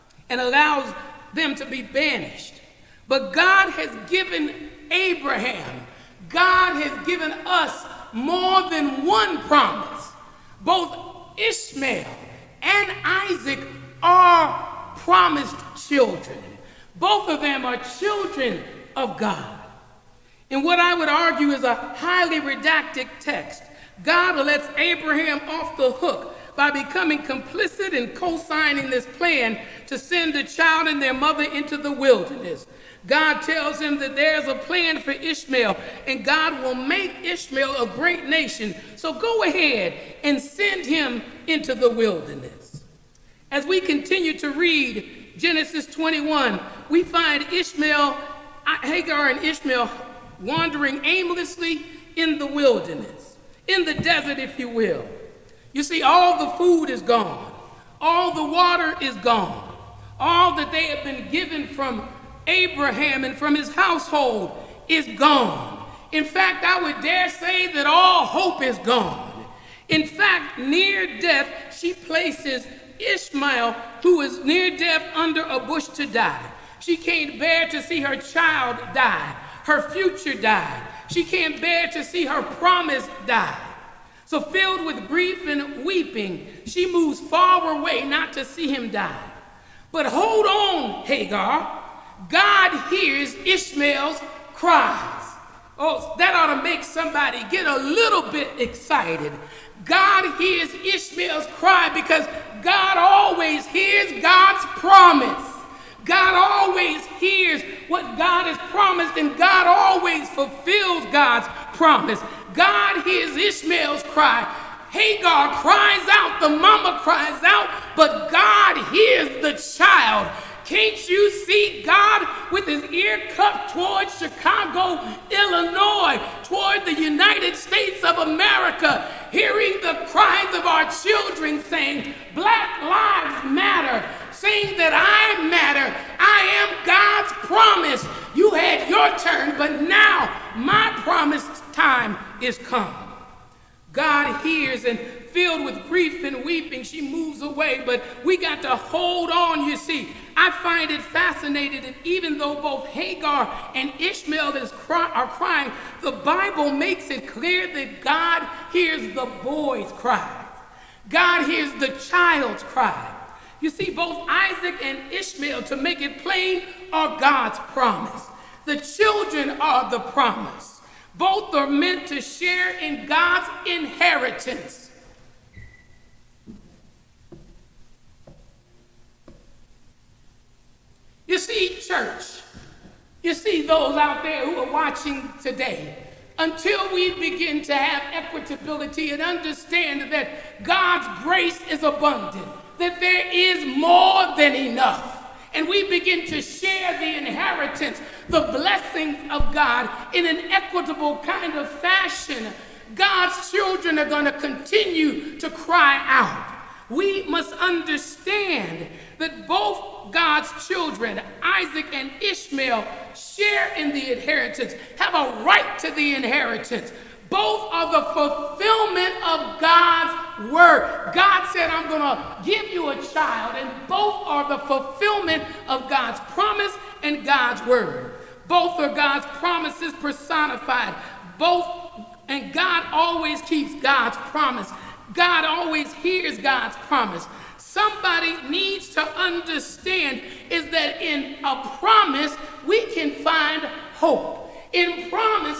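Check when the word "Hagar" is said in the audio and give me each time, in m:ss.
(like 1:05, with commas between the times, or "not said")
0:48, 1:31, 1:54, 2:32.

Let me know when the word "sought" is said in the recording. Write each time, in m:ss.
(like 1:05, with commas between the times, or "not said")
not said.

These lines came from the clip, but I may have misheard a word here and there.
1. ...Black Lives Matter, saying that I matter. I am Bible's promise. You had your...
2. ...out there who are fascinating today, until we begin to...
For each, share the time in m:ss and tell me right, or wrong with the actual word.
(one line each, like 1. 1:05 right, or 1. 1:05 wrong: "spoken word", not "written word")
1. 2:12 wrong: "God", not "Bible"
2. 3:03 wrong: "watching", not "fascinating".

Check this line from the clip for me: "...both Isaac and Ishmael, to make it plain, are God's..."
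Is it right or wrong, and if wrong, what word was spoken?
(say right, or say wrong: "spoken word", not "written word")
right.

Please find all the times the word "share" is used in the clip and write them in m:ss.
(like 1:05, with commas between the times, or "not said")
2:52, 3:16, 3:33.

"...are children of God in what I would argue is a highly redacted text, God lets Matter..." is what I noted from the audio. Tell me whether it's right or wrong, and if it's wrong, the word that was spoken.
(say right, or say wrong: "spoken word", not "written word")
wrong: "Abraham", not "Matter".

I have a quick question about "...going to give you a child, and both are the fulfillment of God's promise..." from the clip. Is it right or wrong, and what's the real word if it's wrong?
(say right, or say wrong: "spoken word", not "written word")
right.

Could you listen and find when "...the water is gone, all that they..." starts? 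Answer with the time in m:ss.
0:58.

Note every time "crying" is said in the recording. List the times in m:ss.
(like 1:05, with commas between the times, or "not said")
2:35.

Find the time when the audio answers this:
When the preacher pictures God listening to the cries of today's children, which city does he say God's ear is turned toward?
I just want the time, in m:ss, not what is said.
2:04.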